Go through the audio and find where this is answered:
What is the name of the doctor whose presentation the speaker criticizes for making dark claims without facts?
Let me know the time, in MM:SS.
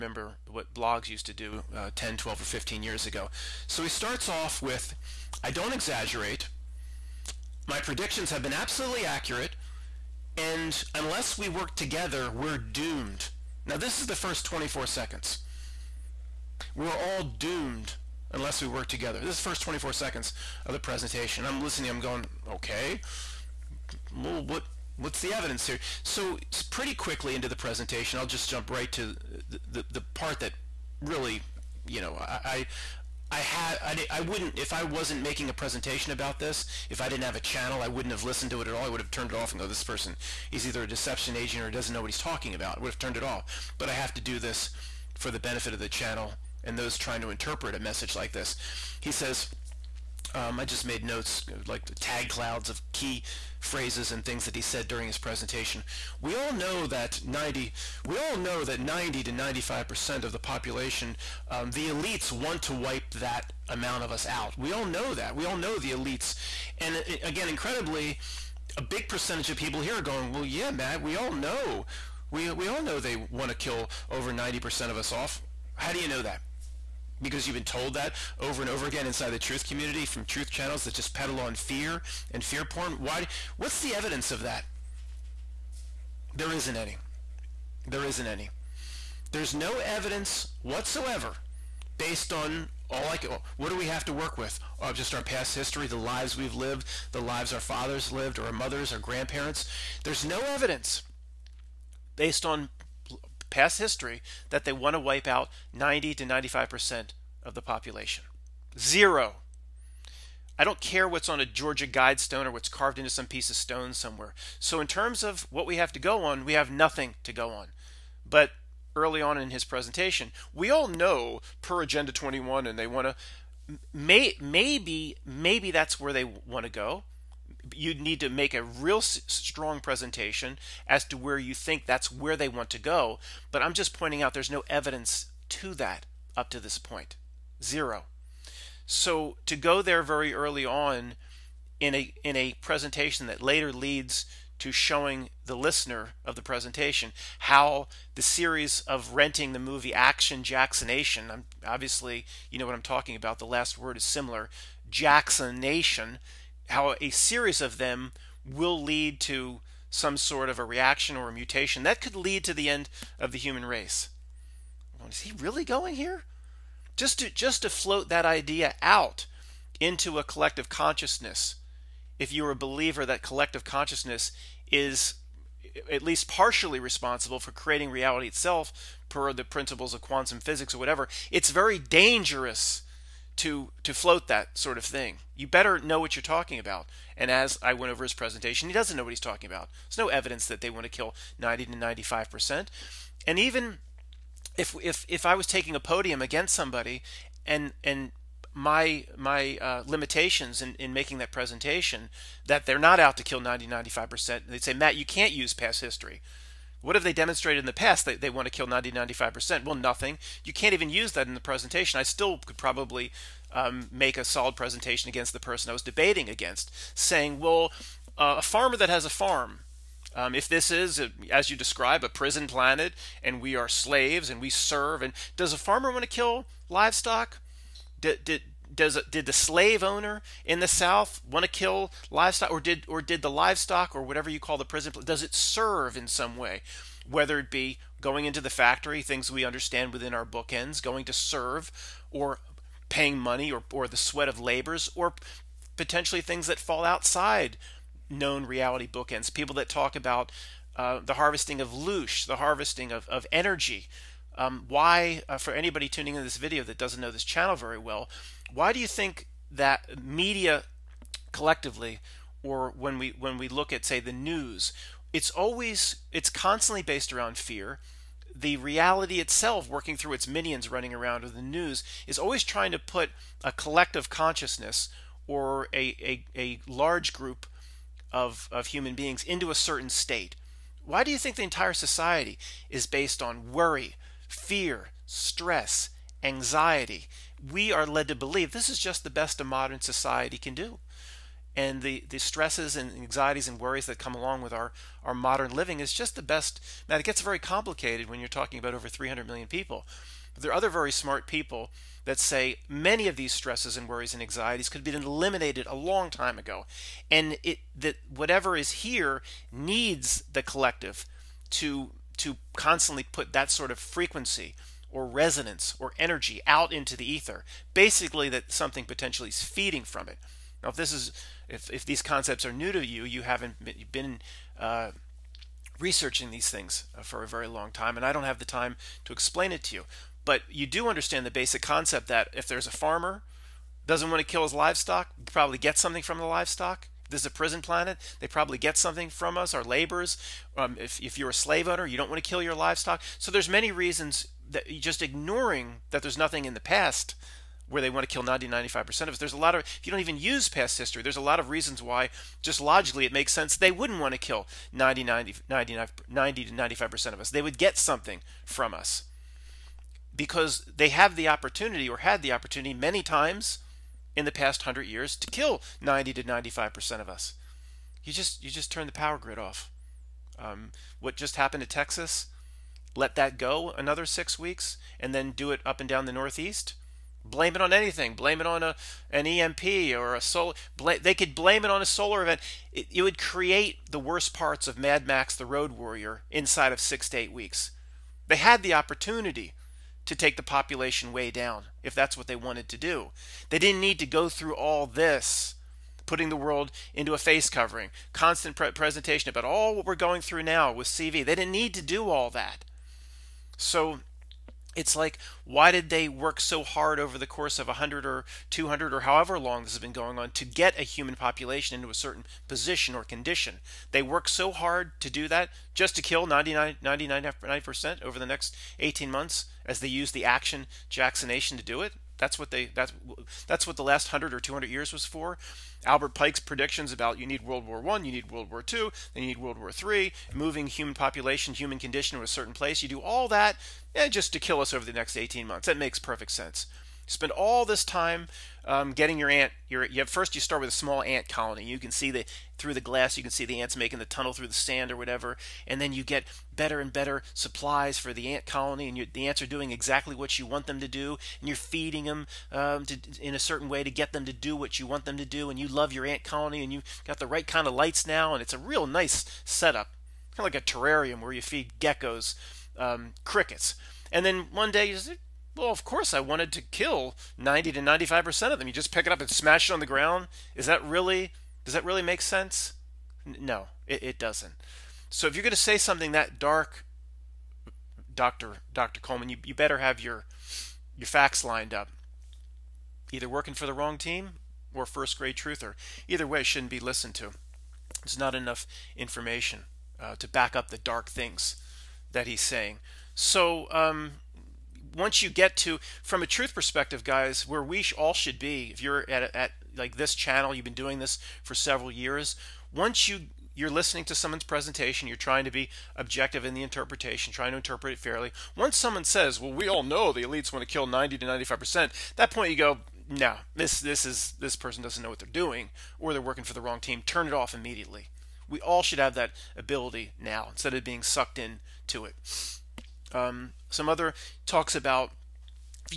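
07:58.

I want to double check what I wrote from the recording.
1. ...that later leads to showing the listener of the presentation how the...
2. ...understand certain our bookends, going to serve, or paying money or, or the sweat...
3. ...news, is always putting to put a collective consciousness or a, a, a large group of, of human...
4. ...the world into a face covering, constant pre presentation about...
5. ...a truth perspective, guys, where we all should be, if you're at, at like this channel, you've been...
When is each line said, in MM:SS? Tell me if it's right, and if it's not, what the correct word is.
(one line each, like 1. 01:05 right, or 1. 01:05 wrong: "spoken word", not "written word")
1. 02:23 right
2. 03:59 wrong: "within", not "certain"
3. 04:31 wrong: "trying", not "putting"
4. 06:36 right
5. 08:16 right.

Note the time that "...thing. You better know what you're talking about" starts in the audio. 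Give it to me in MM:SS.
03:04.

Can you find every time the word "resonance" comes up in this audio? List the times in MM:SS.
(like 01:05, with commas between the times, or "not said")
05:15.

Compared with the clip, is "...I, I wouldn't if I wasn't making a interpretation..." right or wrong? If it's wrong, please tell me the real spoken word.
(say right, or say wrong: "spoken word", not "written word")
wrong: "presentation", not "interpretation".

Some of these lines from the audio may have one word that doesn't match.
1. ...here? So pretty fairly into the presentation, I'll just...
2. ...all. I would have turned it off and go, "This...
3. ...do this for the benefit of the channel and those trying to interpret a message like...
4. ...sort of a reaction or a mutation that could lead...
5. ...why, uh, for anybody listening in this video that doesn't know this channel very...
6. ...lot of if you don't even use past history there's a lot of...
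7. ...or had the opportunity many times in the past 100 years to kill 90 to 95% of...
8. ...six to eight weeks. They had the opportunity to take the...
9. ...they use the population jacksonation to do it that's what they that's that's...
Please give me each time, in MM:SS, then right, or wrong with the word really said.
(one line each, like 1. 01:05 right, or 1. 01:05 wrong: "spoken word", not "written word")
1. 00:25 wrong: "quickly", not "fairly"
2. 00:38 right
3. 00:44 right
4. 02:40 right
5. 04:14 wrong: "tuning", not "listening"
6. 05:49 right
7. 06:01 right
8. 06:26 right
9. 06:59 wrong: "action", not "population".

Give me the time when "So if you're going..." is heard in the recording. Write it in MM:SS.
07:55.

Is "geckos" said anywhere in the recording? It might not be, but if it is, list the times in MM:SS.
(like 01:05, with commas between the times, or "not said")
07:41.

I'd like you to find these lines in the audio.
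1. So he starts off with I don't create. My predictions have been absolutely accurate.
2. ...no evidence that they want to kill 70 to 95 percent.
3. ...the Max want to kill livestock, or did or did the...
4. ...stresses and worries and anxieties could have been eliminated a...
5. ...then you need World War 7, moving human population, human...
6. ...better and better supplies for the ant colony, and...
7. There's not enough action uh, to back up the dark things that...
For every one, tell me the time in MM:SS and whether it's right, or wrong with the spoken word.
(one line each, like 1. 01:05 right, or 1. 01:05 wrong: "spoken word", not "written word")
1. 00:03 wrong: "exaggerate", not "create"
2. 03:10 wrong: "90", not "70"
3. 03:50 wrong: "South", not "Max"
4. 05:03 right
5. 07:09 wrong: "3", not "7"
6. 07:26 right
7. 08:08 wrong: "information", not "action".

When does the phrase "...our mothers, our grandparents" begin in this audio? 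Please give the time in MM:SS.
01:38.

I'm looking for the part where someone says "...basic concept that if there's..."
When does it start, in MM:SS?
05:31.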